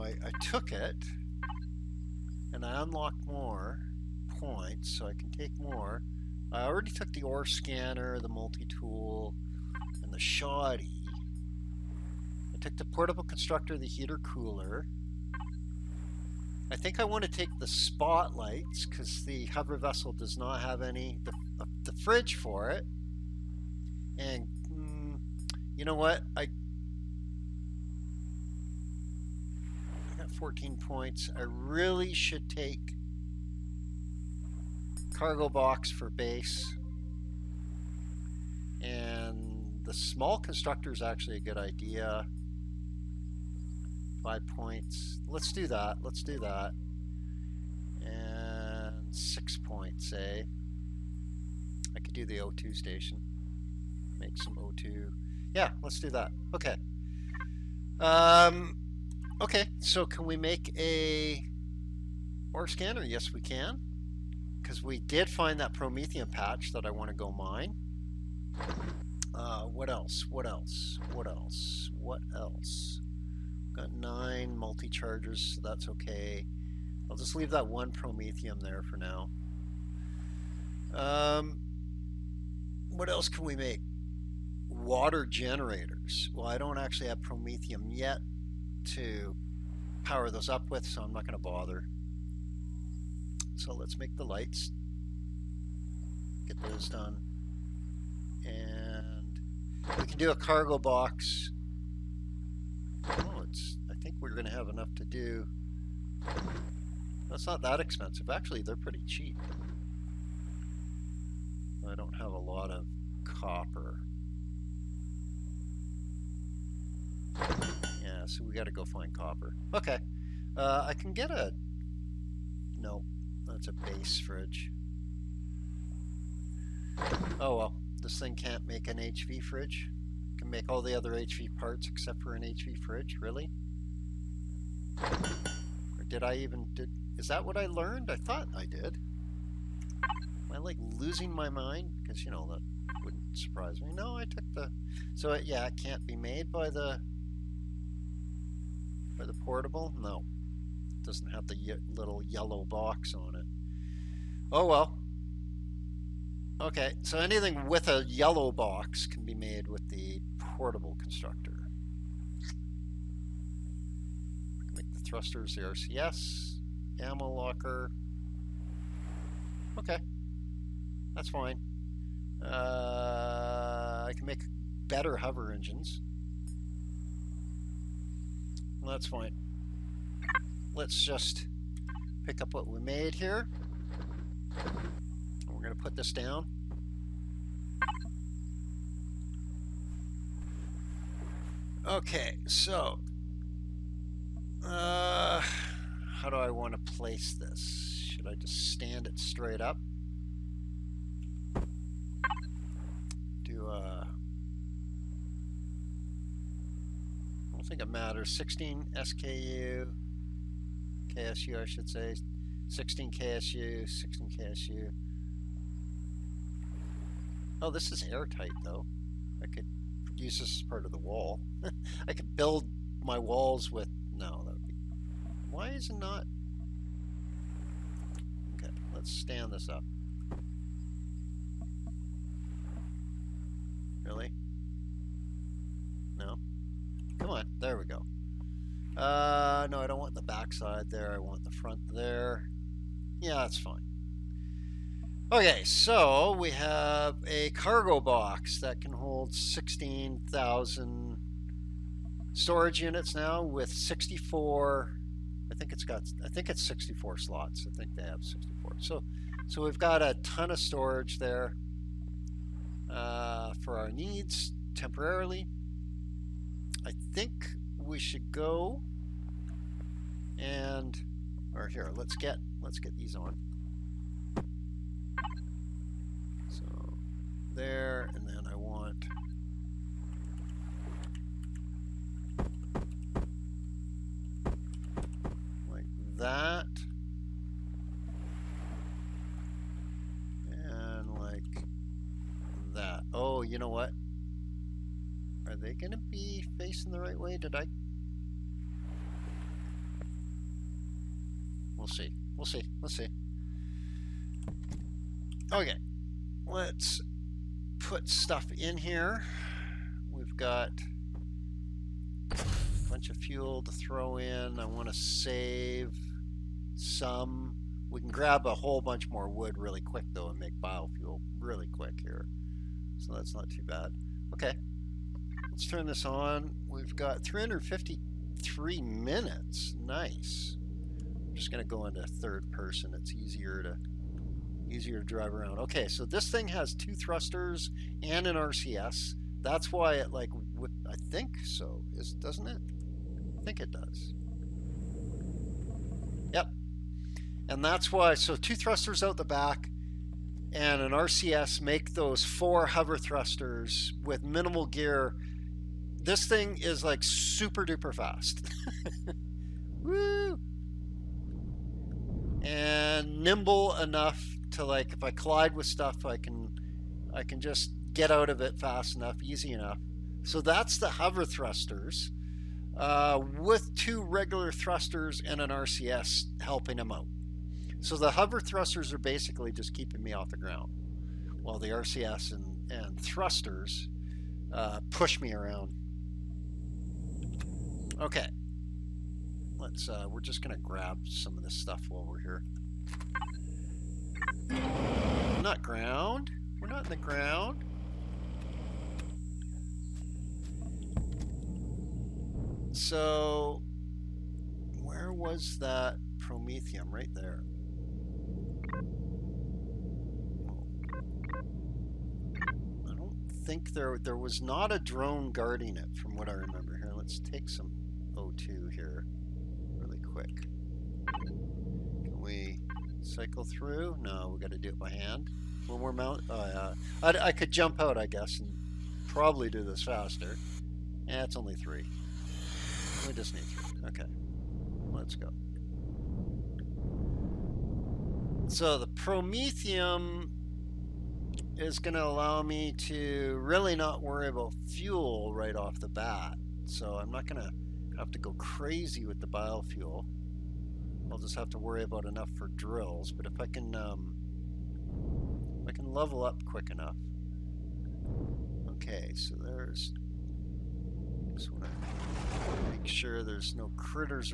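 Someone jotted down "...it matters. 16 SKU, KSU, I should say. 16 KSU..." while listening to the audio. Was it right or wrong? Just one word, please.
right.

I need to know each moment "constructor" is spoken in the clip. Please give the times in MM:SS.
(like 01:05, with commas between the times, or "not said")
00:13, 00:40, 02:41.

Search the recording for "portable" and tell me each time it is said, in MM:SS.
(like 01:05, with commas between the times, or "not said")
00:12, 02:29, 02:40.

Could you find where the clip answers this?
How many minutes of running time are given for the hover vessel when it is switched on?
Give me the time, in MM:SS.
05:27.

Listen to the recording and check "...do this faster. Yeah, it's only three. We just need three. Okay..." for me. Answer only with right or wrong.
right.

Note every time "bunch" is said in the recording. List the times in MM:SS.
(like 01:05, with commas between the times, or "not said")
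05:12, 05:18.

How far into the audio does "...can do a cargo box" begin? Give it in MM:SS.
01:40.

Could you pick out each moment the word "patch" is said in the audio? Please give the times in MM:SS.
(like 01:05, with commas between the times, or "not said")
01:06.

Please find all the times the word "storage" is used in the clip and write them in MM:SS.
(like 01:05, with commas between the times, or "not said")
04:12, 04:20.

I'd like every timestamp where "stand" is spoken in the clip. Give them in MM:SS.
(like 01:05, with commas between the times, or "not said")
03:18, 03:49.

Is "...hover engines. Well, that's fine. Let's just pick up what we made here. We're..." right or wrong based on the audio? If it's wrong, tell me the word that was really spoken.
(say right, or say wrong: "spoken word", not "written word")
right.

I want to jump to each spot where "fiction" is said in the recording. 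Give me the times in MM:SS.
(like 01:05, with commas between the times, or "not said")
not said.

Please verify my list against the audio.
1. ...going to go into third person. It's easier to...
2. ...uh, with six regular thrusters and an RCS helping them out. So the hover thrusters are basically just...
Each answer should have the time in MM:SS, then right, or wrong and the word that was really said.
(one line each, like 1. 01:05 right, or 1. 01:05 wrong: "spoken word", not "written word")
1. 05:31 right
2. 06:12 wrong: "two", not "six".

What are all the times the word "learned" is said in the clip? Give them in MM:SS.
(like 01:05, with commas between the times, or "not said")
02:17.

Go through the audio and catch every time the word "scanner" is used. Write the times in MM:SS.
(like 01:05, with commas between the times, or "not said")
00:07, 01:02.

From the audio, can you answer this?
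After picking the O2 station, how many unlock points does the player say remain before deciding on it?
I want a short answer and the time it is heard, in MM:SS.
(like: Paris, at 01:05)
6, at 00:49.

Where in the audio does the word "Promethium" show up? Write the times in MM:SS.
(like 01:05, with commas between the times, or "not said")
01:05, 01:17, 01:27, 06:46, 07:18.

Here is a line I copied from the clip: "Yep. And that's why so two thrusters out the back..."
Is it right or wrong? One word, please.
right.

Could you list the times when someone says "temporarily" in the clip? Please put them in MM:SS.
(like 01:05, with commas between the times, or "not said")
04:24.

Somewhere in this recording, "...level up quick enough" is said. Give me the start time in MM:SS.
07:35.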